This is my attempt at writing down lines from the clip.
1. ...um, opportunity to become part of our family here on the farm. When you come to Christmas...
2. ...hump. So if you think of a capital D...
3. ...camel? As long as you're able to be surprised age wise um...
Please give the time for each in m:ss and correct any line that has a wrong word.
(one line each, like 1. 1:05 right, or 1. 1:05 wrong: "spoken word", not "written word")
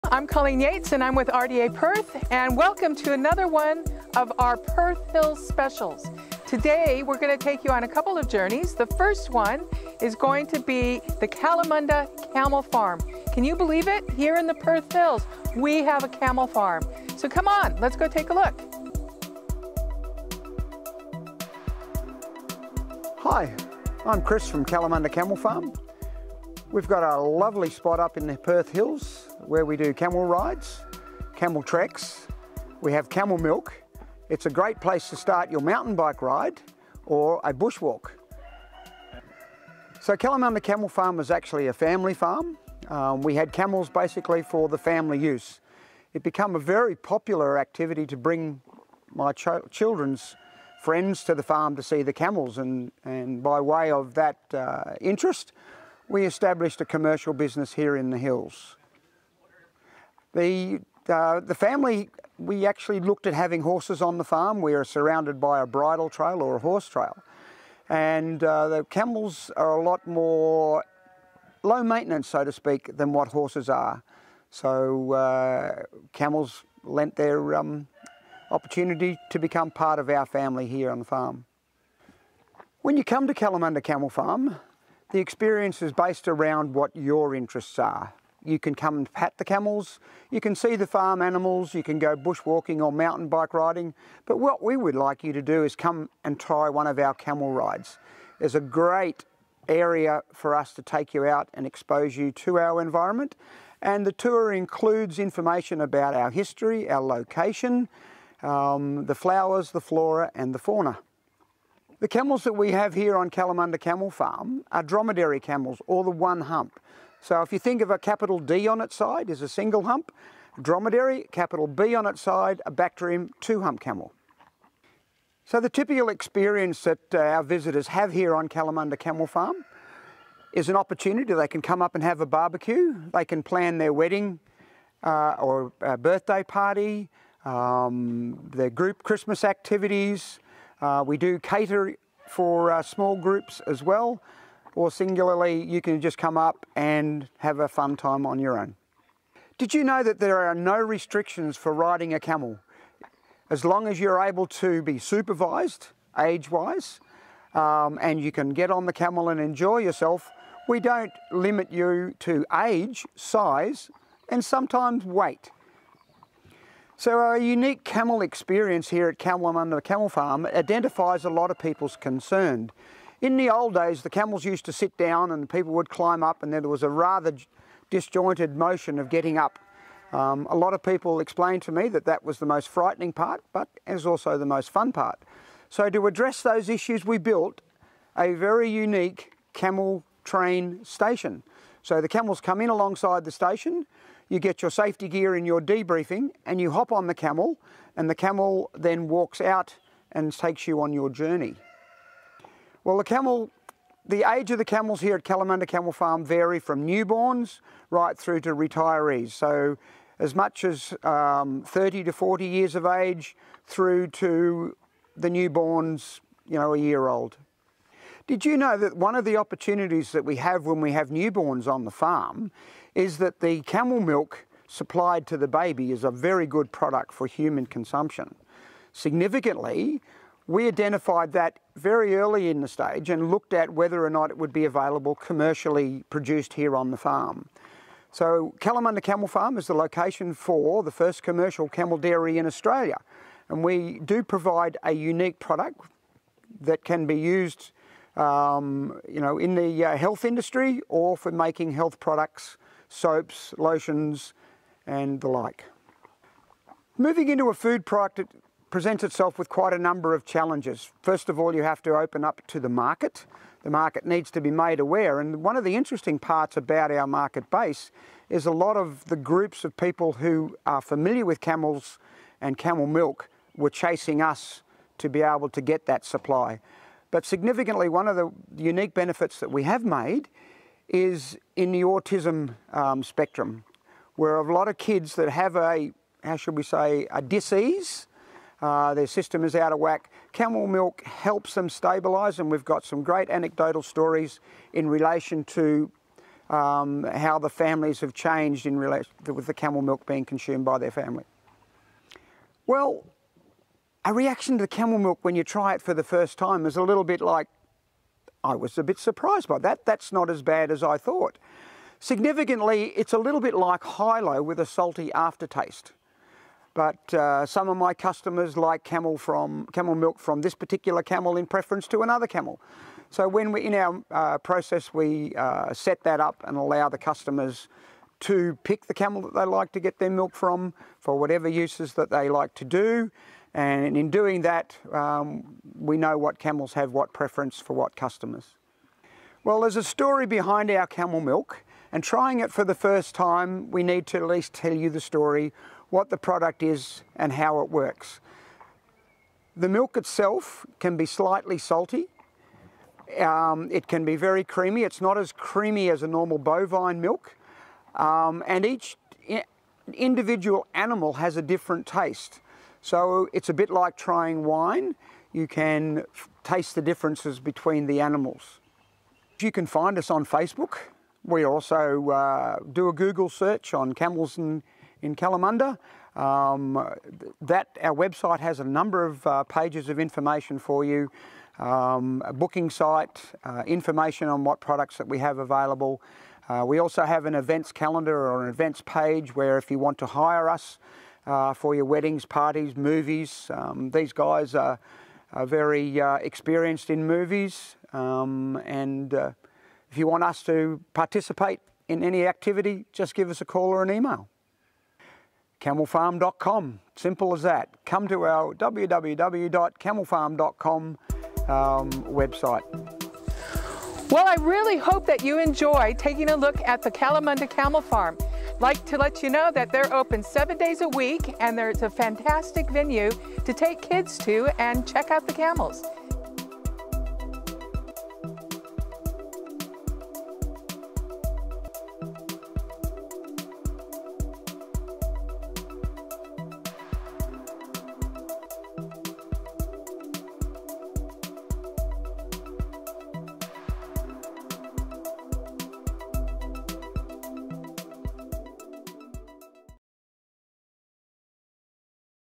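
1. 1:17 wrong: "Kalamunda", not "Christmas"
2. 1:56 right
3. 2:32 wrong: "supervised", not "surprised".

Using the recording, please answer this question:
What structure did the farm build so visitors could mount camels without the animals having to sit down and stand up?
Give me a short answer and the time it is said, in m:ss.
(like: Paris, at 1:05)
Camel train station, at 3:09.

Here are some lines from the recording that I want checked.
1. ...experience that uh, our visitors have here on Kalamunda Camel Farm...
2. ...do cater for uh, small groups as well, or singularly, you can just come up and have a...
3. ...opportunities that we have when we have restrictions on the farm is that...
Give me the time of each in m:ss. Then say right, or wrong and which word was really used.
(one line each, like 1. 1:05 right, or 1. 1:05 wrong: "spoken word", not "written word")
1. 2:06 right
2. 2:21 right
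3. 3:39 wrong: "newborns", not "restrictions".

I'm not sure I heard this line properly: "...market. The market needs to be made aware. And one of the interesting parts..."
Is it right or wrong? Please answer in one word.
right.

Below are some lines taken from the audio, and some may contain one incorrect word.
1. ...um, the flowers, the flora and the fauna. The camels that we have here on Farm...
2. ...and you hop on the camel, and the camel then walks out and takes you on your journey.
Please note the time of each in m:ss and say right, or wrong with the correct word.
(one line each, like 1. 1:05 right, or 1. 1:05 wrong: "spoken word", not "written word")
1. 1:48 wrong: "Kalamunda", not "Farm"
2. 3:16 right.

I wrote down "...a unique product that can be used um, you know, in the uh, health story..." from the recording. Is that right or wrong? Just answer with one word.
wrong.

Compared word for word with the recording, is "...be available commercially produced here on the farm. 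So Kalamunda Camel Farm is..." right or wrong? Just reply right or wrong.
right.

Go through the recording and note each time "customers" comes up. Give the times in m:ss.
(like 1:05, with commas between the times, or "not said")
5:17, 5:26, 5:37.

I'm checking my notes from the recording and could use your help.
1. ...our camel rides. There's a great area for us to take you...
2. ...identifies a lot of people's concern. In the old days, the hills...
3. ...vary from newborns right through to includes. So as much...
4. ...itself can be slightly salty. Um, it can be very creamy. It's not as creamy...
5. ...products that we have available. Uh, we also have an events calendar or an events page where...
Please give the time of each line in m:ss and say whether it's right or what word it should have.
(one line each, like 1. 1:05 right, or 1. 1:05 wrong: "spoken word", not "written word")
1. 1:36 right
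2. 2:50 wrong: "camels", not "hills"
3. 3:26 wrong: "retirees", not "includes"
4. 5:49 right
5. 6:24 right.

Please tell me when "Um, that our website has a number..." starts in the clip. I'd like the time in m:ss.
6:16.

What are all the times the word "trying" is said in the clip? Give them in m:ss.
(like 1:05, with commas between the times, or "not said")
5:42, 6:03.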